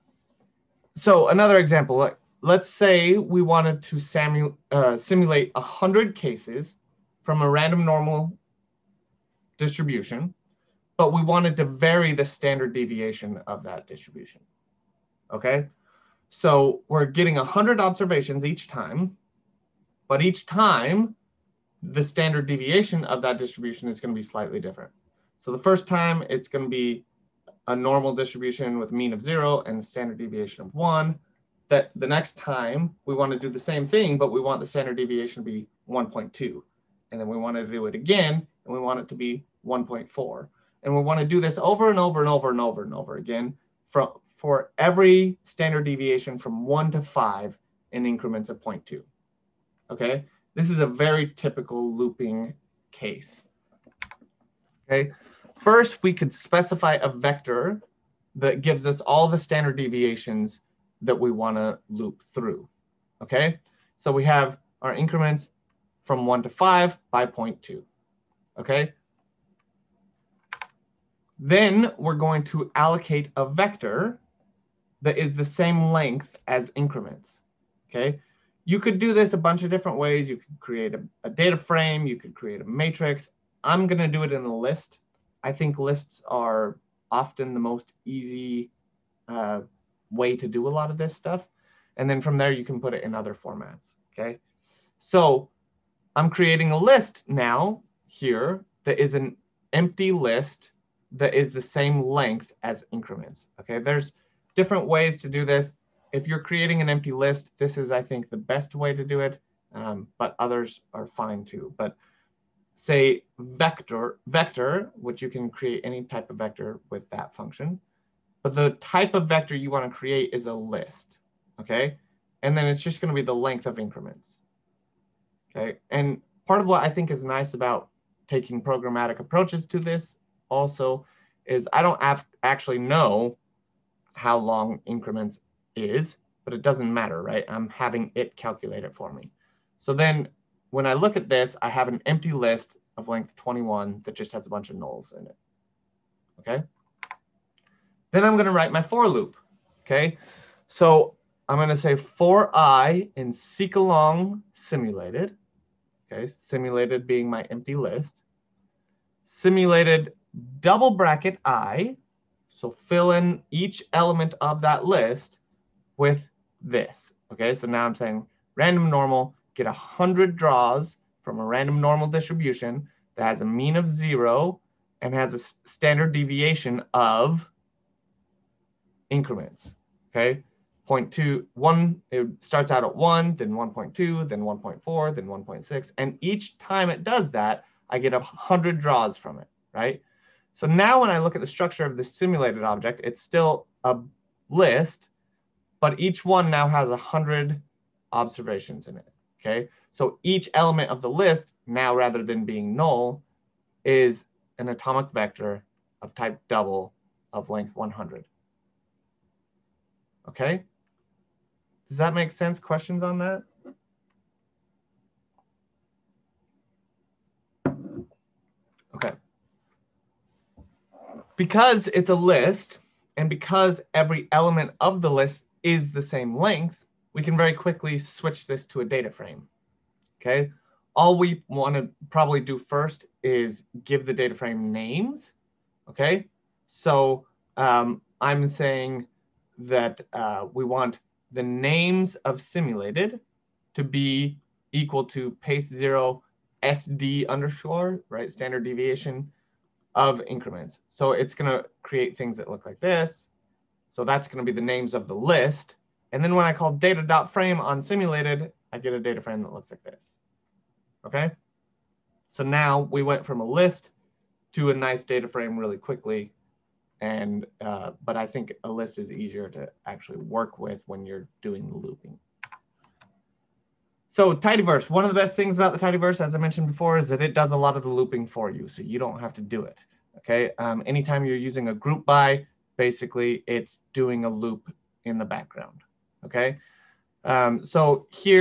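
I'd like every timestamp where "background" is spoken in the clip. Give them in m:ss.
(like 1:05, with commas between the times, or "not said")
4:45.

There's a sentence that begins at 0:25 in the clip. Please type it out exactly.
So the first time, it's going to be a normal distribution with mean of zero and a standard deviation of one.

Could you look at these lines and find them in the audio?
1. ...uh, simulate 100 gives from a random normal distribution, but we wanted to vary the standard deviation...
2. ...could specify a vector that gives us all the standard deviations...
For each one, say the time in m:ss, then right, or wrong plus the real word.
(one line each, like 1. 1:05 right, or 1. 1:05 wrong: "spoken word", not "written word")
1. 0:04 wrong: "cases", not "gives"
2. 0:56 right.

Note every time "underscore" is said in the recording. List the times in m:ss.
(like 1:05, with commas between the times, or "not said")
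4:07.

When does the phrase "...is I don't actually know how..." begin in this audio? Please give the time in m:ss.
2:11.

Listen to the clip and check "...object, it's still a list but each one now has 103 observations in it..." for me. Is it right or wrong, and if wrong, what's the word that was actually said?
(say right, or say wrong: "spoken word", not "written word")
wrong: "100", not "103".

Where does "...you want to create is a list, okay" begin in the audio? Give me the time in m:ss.
1:59.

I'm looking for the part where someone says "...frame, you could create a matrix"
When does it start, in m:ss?
1:21.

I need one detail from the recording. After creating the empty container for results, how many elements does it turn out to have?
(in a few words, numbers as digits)
21.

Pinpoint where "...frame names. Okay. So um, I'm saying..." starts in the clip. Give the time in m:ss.
3:54.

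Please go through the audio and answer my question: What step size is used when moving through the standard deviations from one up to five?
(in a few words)
0.2.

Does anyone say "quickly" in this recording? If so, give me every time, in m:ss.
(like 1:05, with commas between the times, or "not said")
3:47, 4:25.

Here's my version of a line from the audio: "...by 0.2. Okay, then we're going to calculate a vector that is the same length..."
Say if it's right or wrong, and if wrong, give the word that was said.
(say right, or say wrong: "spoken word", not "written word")
wrong: "allocate", not "calculate".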